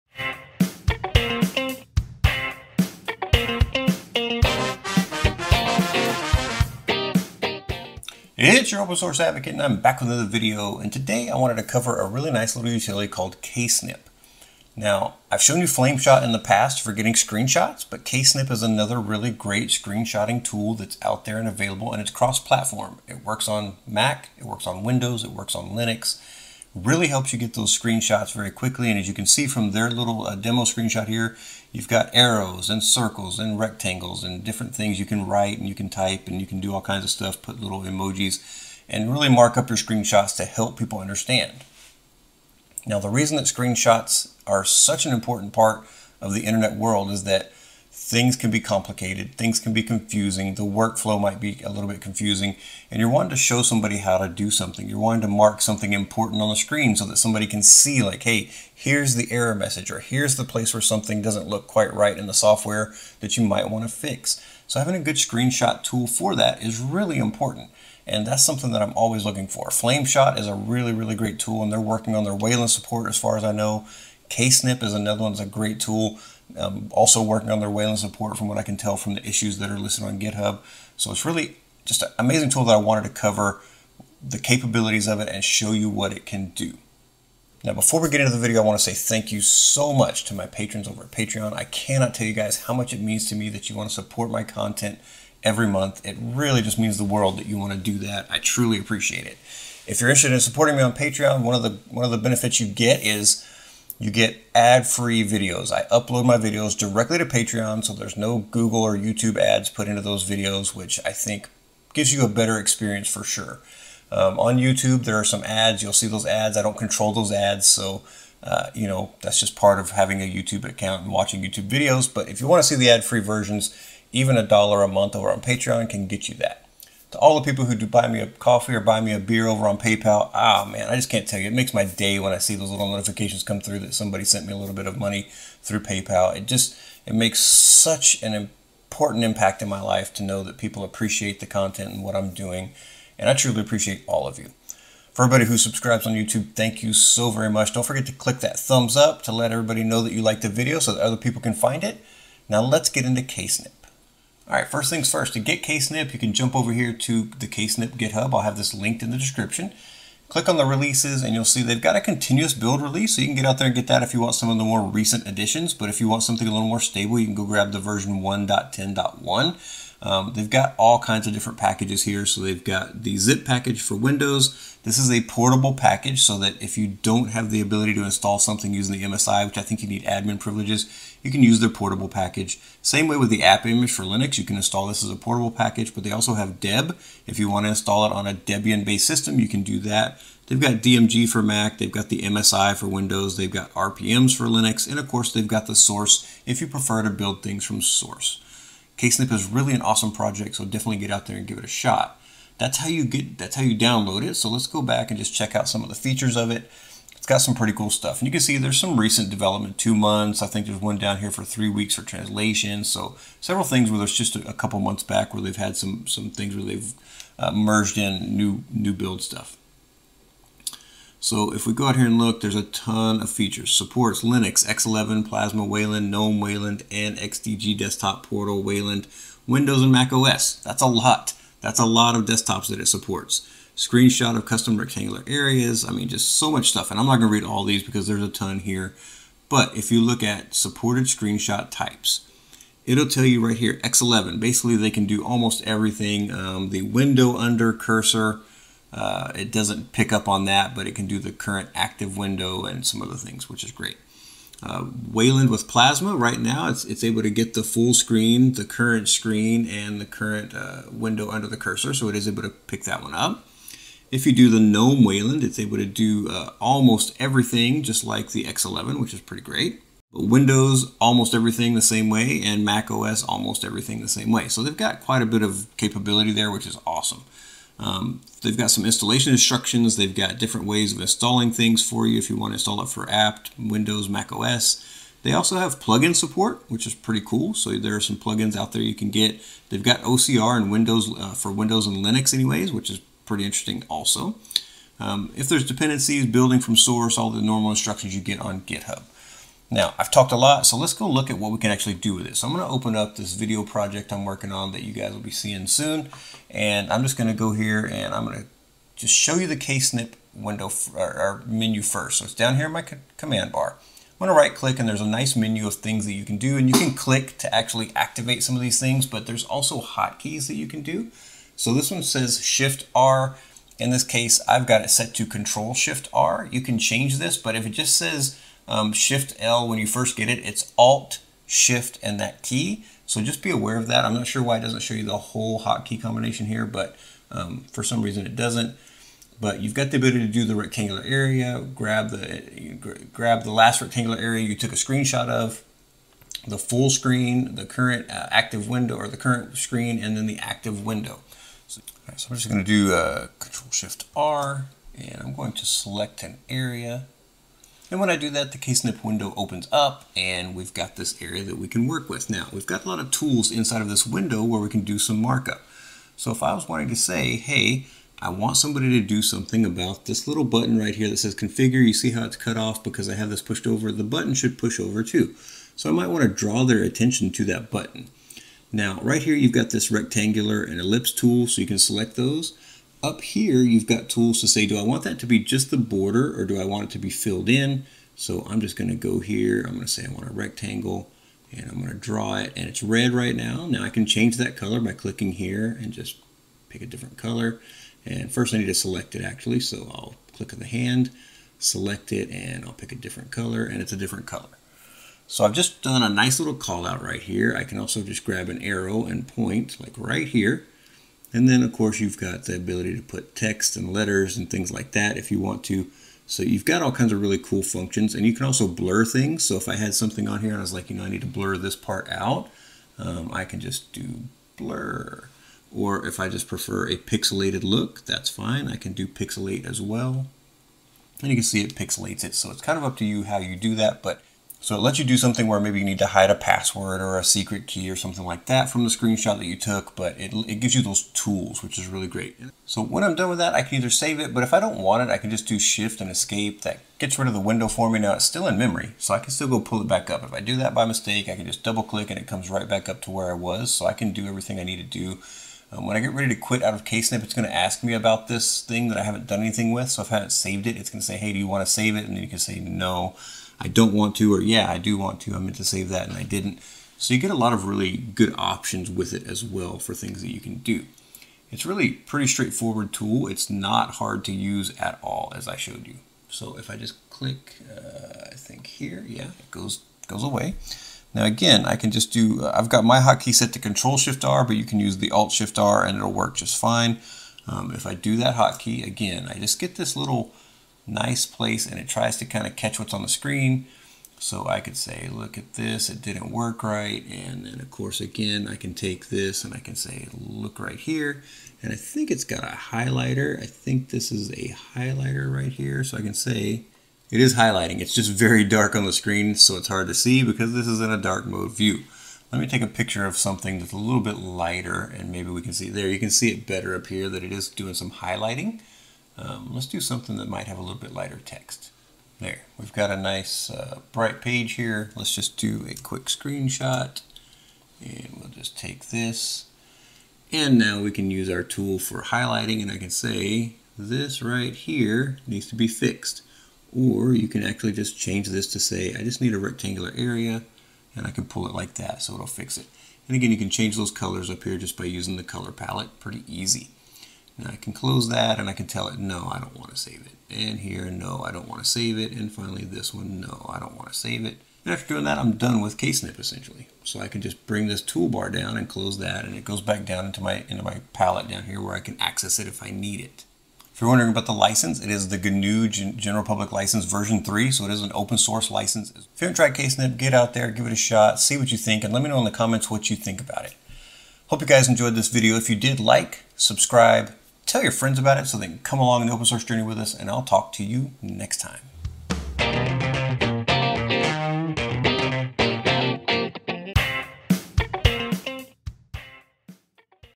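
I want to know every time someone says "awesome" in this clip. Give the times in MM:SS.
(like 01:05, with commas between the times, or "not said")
03:19, 04:36.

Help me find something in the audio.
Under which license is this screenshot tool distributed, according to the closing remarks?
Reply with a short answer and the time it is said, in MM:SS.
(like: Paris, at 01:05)
GNU General Public License version 3, at 09:25.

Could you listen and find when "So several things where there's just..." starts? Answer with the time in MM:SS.
03:32.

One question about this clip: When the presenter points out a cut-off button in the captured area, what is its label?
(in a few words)
configure.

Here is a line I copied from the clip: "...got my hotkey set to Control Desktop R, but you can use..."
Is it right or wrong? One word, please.
wrong.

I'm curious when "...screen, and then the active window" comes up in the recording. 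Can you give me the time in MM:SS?
05:49.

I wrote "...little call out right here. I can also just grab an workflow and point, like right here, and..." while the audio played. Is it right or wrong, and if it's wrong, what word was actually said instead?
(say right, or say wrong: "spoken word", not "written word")
wrong: "arrow", not "workflow".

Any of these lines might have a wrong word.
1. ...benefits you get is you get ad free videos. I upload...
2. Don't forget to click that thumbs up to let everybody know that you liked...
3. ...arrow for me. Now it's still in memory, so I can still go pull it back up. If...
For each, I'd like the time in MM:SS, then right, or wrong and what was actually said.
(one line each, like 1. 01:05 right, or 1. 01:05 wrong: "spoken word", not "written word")
1. 01:42 right
2. 02:27 right
3. 07:27 wrong: "window", not "arrow".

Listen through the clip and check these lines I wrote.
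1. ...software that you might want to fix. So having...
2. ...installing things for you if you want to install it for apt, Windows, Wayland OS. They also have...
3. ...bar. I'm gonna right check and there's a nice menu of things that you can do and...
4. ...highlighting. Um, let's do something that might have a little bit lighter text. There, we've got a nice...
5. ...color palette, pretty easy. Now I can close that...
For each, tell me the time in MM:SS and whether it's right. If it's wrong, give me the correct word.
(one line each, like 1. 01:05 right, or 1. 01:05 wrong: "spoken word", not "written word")
1. 01:02 right
2. 04:41 wrong: "Mac", not "Wayland"
3. 05:13 wrong: "click", not "check"
4. 08:37 right
5. 09:05 right.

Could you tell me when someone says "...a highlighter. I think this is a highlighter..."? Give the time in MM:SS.
08:22.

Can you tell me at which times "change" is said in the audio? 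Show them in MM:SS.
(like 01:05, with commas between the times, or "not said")
05:26, 06:34, 08:57, 09:03.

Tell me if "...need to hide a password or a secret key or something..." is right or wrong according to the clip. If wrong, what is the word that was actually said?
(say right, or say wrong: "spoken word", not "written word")
right.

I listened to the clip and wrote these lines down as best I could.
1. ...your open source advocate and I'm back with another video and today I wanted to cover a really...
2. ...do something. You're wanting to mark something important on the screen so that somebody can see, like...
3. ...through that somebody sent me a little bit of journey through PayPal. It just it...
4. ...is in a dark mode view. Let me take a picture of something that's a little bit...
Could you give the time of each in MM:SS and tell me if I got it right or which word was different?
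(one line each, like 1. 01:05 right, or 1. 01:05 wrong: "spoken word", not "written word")
1. 00:08 right
2. 00:54 right
3. 02:13 wrong: "money", not "journey"
4. 08:30 right.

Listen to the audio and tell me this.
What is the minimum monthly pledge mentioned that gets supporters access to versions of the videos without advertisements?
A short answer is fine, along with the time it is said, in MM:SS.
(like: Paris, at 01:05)
a dollar a month, at 02:04.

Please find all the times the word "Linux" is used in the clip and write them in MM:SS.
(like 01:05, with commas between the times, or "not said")
00:25, 03:04, 03:14, 03:44, 04:52.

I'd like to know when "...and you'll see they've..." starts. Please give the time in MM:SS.
02:41.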